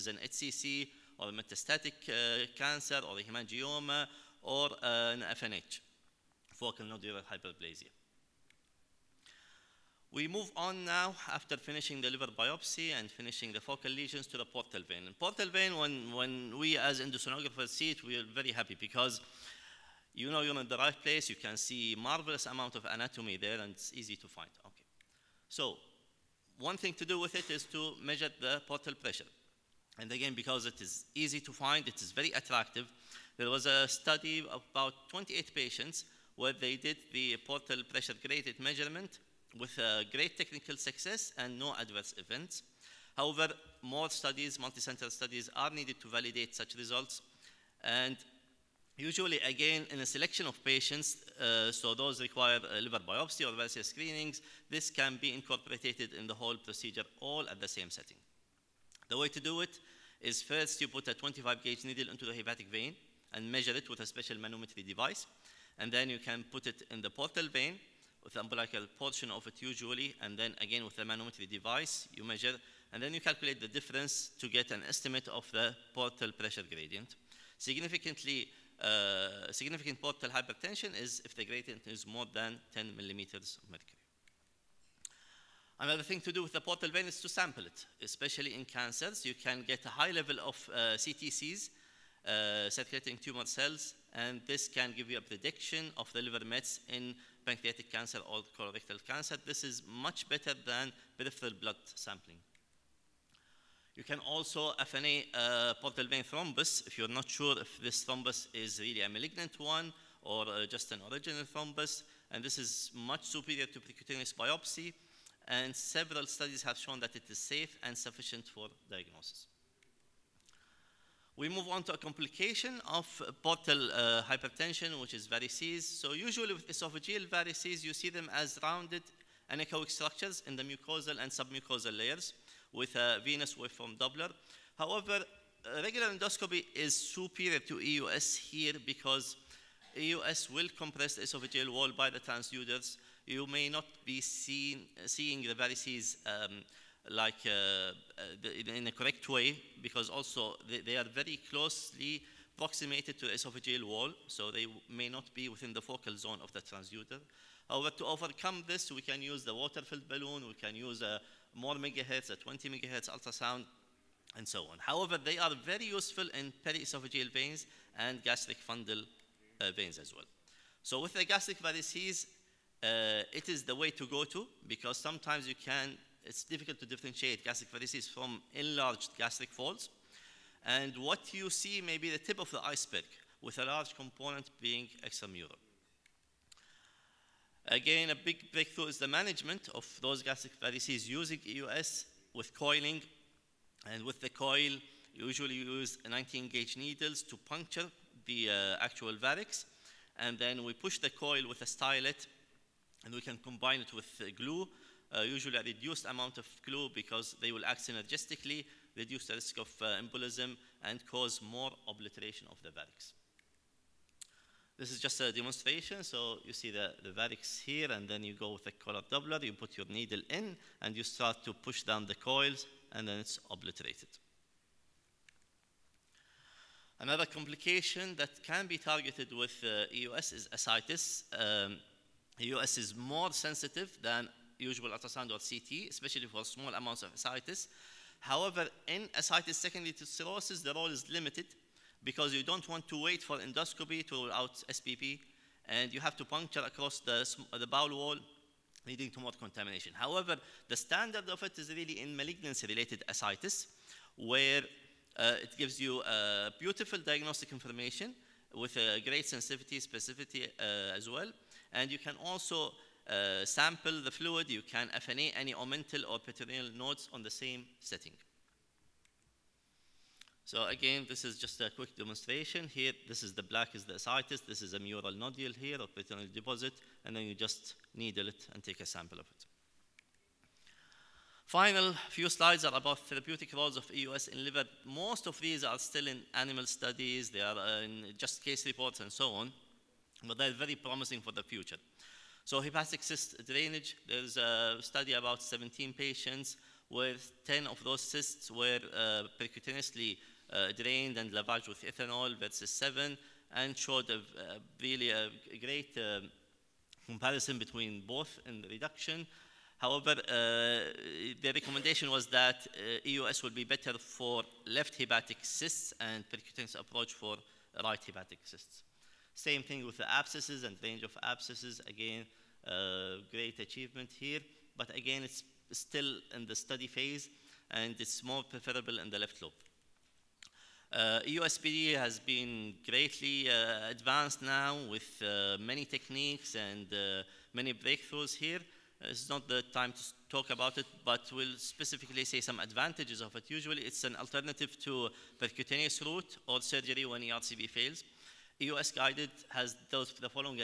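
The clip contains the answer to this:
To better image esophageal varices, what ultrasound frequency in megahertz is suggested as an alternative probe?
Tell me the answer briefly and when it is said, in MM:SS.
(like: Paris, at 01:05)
20 megahertz, at 02:42.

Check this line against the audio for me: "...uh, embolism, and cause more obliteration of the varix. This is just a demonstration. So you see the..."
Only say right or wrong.
right.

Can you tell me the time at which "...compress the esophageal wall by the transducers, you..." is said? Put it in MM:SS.
02:20.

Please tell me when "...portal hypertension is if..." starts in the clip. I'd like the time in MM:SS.
01:19.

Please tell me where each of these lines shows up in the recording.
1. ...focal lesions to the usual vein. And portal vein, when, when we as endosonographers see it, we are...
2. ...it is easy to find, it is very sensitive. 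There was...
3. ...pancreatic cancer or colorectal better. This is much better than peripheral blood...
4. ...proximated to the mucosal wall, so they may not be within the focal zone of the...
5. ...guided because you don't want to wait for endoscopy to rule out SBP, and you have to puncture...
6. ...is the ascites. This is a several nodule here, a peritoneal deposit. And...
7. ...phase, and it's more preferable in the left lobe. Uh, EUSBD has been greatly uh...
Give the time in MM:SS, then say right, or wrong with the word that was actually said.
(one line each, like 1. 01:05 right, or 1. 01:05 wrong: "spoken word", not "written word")
1. 00:13 wrong: "portal", not "usual"
2. 00:30 wrong: "attractive", not "sensitive"
3. 01:37 wrong: "cancer", not "better"
4. 02:32 wrong: "esophageal", not "mucosal"
5. 04:01 wrong: "limited", not "guided"
6. 04:33 wrong: "mural", not "several"
7. 05:26 right.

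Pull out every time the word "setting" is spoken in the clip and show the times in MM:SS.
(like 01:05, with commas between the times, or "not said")
00:57, 04:27.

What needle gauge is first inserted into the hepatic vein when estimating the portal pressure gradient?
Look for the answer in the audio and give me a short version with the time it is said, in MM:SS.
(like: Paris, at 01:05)
25 gauge, at 01:01.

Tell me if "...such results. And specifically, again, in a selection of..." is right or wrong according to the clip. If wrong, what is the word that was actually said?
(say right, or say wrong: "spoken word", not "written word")
wrong: "usually", not "specifically".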